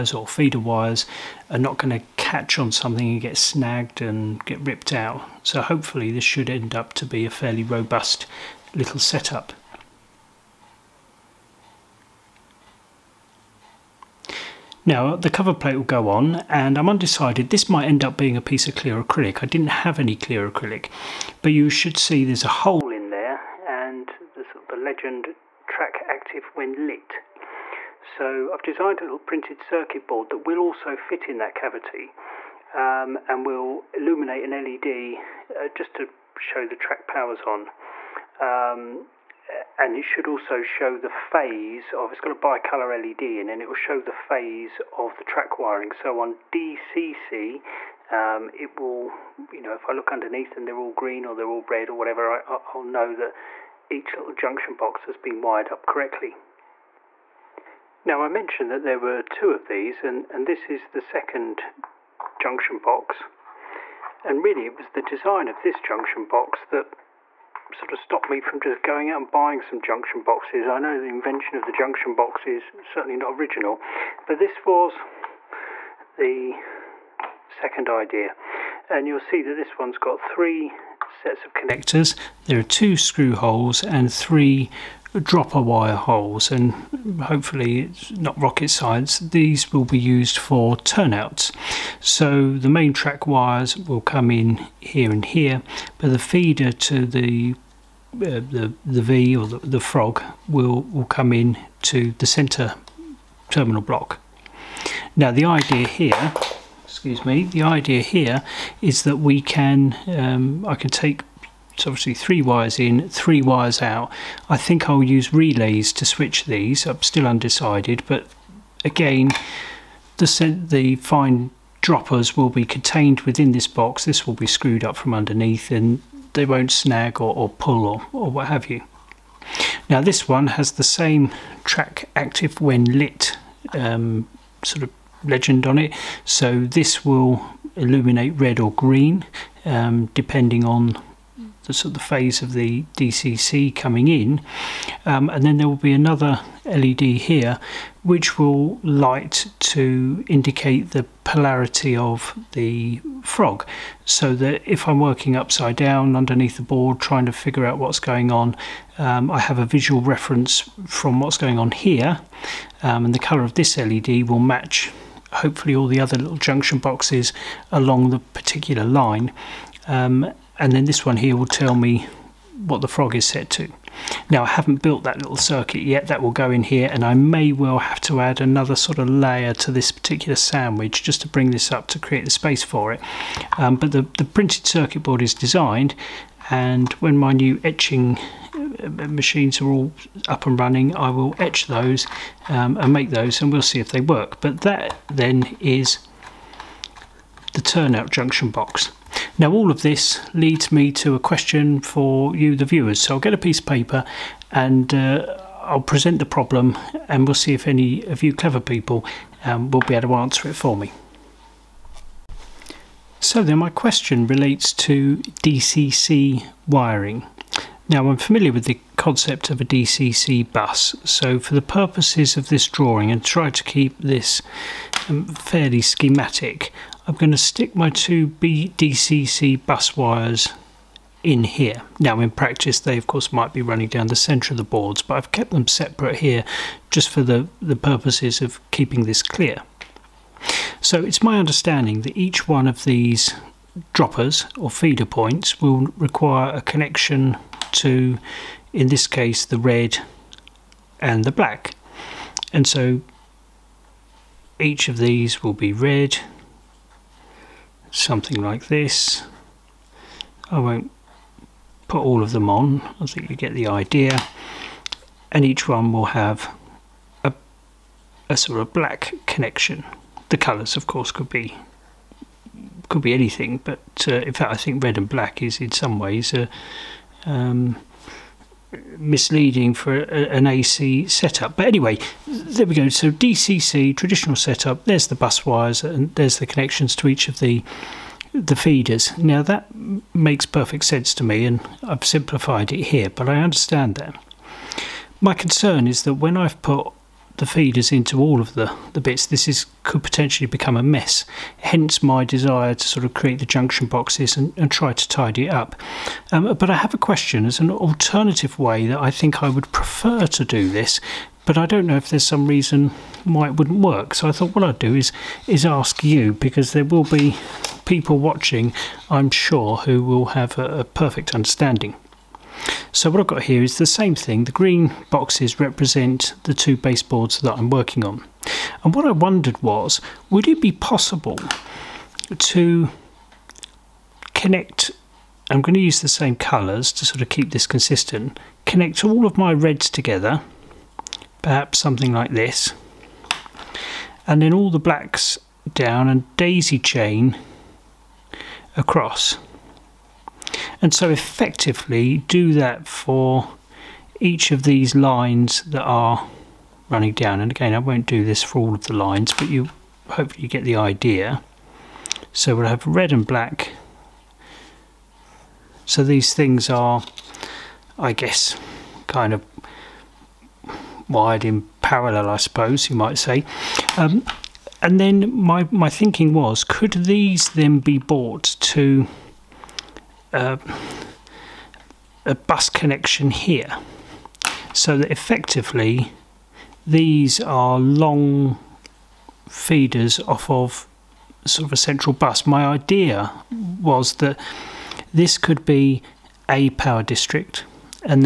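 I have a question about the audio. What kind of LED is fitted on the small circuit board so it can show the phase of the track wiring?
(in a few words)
bicolor LED.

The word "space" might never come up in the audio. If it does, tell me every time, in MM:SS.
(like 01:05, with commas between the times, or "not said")
03:02.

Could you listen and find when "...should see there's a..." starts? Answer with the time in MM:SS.
00:21.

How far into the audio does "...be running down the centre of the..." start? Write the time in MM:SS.
03:53.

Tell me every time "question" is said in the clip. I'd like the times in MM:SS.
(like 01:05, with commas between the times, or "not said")
03:21, 03:33, 05:06.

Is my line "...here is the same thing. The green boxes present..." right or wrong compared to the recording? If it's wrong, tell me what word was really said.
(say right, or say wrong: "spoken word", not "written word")
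wrong: "represent", not "present".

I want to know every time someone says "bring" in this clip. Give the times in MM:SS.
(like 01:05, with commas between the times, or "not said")
03:01.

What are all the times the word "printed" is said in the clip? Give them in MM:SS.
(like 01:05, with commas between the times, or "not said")
00:29, 03:04.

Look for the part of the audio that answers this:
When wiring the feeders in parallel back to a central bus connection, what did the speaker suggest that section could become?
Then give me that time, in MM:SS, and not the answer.
06:36.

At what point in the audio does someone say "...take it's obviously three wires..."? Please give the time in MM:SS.
01:50.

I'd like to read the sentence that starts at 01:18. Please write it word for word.
And you'll see that this one's got three sets of connectors.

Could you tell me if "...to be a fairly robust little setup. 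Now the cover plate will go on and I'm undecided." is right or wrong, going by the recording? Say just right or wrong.
right.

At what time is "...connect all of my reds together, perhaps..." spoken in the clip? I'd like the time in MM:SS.
05:38.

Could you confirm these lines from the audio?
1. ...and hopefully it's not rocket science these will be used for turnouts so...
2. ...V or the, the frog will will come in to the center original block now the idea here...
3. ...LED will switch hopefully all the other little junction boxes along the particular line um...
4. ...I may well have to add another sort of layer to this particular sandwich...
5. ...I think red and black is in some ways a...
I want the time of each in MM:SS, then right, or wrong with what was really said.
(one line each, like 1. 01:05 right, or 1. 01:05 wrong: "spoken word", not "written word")
1. 01:26 right
2. 01:39 wrong: "terminal", not "original"
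3. 02:43 wrong: "match", not "switch"
4. 02:57 right
5. 04:34 right.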